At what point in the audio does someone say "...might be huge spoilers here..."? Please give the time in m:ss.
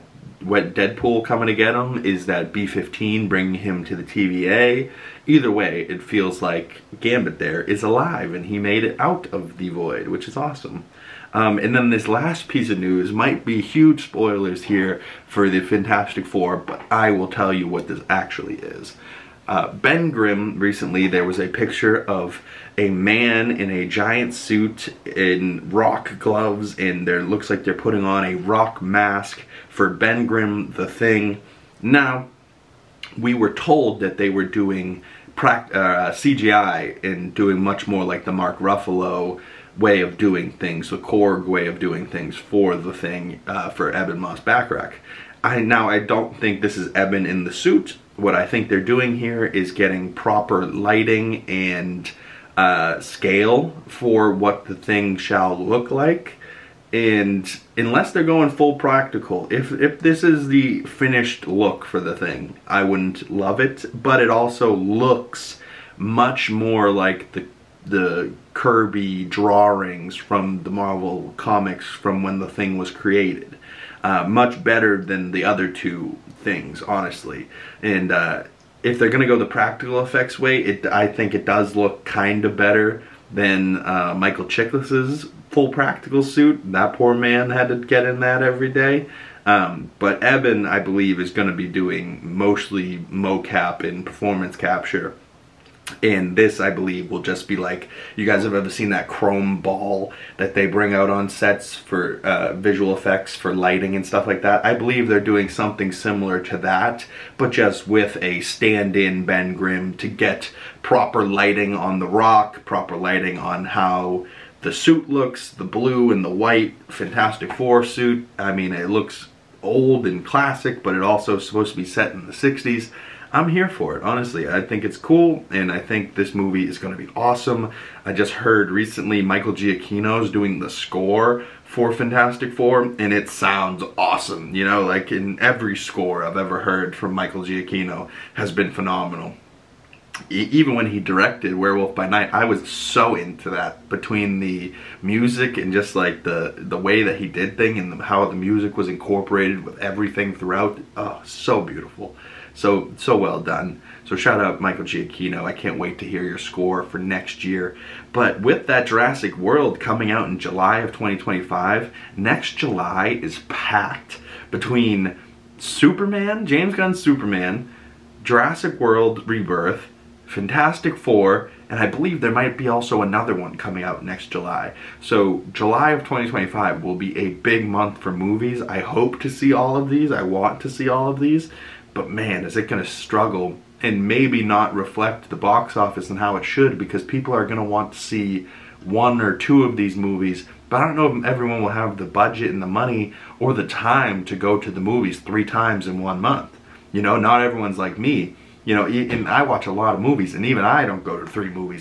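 0:13.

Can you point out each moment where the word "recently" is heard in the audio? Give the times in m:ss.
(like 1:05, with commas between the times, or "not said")
0:20, 2:08.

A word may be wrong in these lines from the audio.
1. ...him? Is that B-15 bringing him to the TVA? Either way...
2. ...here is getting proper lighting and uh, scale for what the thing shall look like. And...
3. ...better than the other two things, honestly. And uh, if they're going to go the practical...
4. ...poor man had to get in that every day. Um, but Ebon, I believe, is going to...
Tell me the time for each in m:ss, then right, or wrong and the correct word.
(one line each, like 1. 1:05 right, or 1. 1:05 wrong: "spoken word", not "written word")
1. 0:01 right
2. 0:49 right
3. 1:14 right
4. 1:26 right.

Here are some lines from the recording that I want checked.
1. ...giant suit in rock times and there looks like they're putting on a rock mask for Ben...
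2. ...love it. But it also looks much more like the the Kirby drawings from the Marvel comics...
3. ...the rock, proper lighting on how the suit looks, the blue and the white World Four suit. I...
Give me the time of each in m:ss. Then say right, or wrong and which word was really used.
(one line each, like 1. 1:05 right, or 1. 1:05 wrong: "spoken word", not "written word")
1. 0:23 wrong: "gloves", not "times"
2. 1:03 right
3. 1:51 wrong: "Fantastic", not "World".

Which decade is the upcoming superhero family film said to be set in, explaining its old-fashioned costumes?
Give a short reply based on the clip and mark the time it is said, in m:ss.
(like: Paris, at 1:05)
the 60s, at 2:02.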